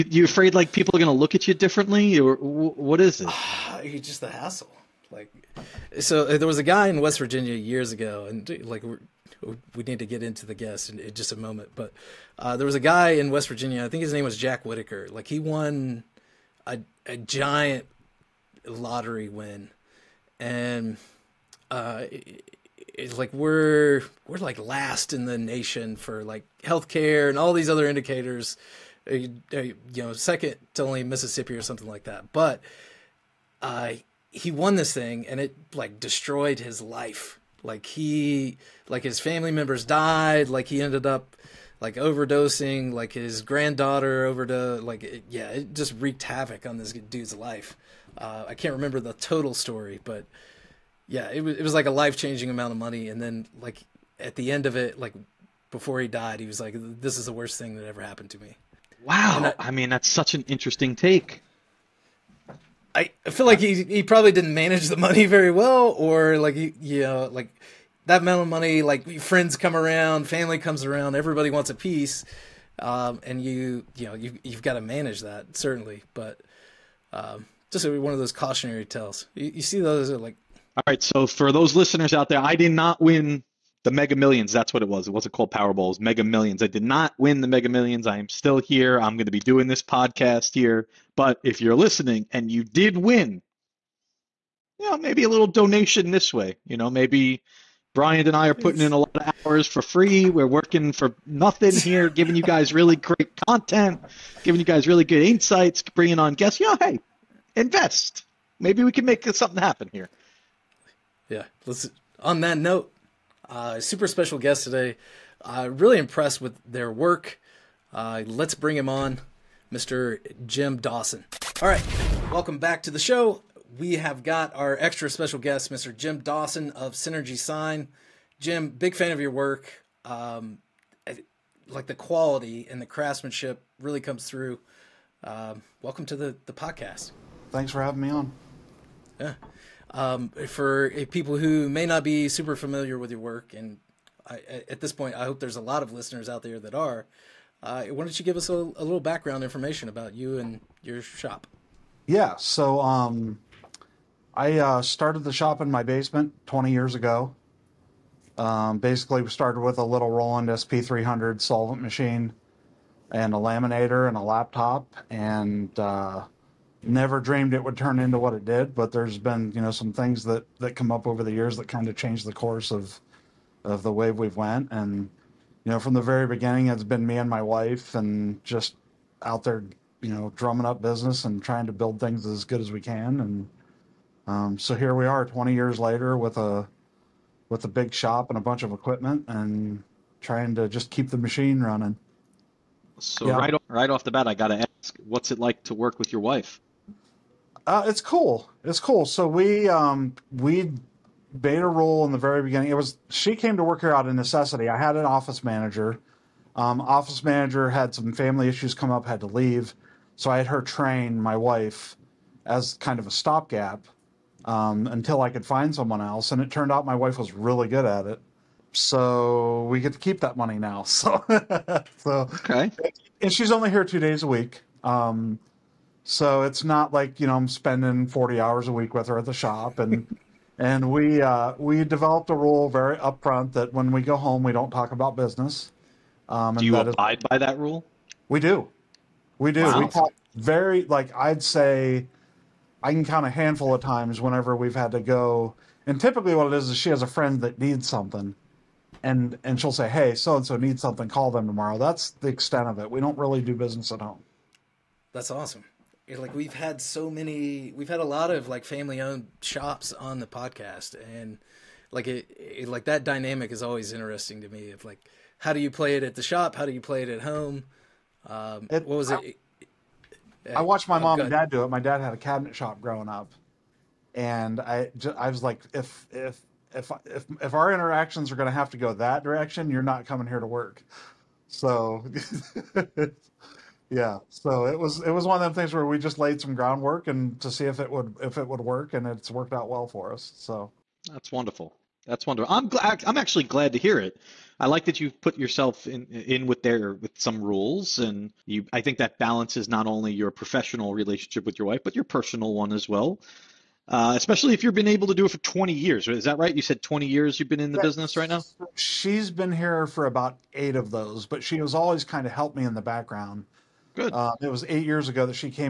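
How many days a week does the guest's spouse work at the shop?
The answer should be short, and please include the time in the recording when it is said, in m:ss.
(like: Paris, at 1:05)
2, at 3:43.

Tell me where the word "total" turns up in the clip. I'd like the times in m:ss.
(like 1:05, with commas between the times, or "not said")
0:49.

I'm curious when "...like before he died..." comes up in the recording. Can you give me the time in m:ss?
0:54.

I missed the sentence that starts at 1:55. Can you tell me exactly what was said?
Uh, really impressed with their work.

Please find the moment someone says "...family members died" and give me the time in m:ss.
0:39.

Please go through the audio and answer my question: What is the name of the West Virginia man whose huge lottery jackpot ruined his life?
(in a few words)
Jack Whitaker.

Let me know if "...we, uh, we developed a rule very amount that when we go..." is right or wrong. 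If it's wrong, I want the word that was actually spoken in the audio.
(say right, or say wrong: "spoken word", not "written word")
wrong: "upfront", not "amount".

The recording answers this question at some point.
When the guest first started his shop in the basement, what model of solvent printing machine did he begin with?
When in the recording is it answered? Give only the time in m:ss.
2:40.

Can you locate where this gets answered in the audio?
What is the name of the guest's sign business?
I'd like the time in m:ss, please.
2:06.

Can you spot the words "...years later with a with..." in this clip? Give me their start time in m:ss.
3:05.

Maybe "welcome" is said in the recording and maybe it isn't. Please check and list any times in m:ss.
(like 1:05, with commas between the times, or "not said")
2:02, 2:15.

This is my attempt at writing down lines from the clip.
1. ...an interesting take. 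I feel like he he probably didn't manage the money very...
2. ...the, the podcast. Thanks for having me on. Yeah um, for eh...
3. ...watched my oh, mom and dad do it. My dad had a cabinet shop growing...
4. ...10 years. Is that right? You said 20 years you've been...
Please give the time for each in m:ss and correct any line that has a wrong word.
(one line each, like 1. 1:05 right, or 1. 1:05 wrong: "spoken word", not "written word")
1. 1:00 right
2. 2:16 right
3. 4:30 right
4. 5:05 wrong: "20", not "10".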